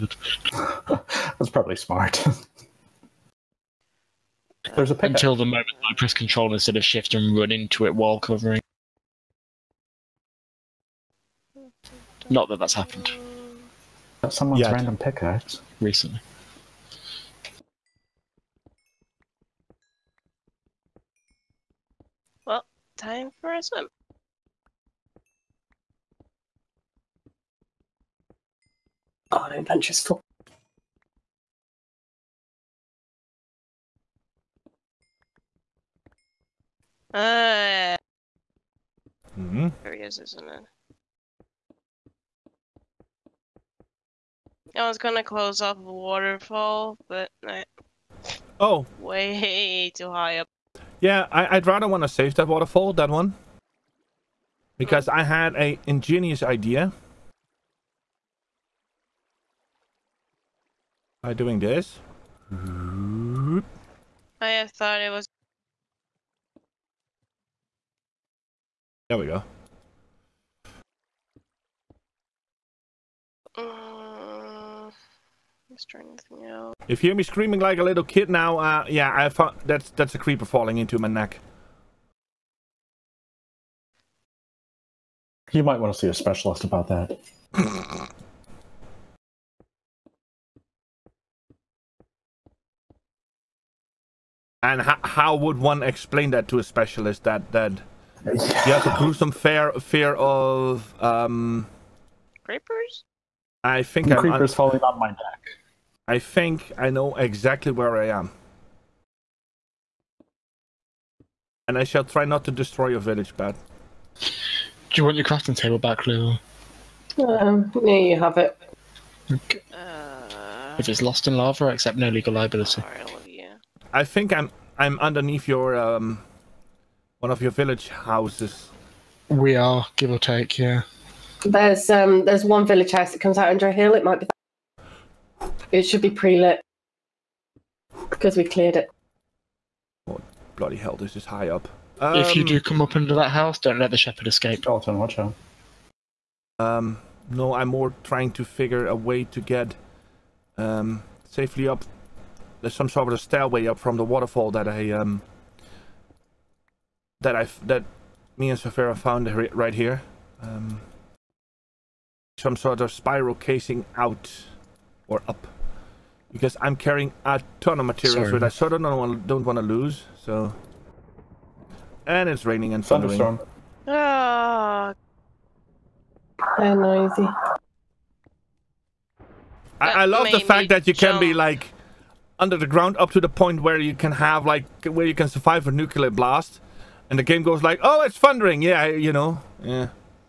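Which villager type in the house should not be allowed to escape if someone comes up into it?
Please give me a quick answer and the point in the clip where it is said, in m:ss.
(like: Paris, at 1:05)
shepherd, at 2:23.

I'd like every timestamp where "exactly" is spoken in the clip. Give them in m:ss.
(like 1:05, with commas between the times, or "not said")
1:47.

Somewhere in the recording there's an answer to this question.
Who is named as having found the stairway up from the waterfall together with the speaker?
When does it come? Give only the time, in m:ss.
2:38.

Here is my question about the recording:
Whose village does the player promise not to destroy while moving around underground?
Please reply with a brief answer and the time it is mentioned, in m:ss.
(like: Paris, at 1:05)
Pat, at 1:53.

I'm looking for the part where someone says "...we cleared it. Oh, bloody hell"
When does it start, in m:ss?
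2:18.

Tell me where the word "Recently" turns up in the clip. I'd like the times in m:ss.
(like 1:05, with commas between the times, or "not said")
0:15.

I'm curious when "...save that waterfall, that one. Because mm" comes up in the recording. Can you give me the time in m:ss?
0:52.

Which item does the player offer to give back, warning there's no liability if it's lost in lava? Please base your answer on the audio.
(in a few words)
crafting table.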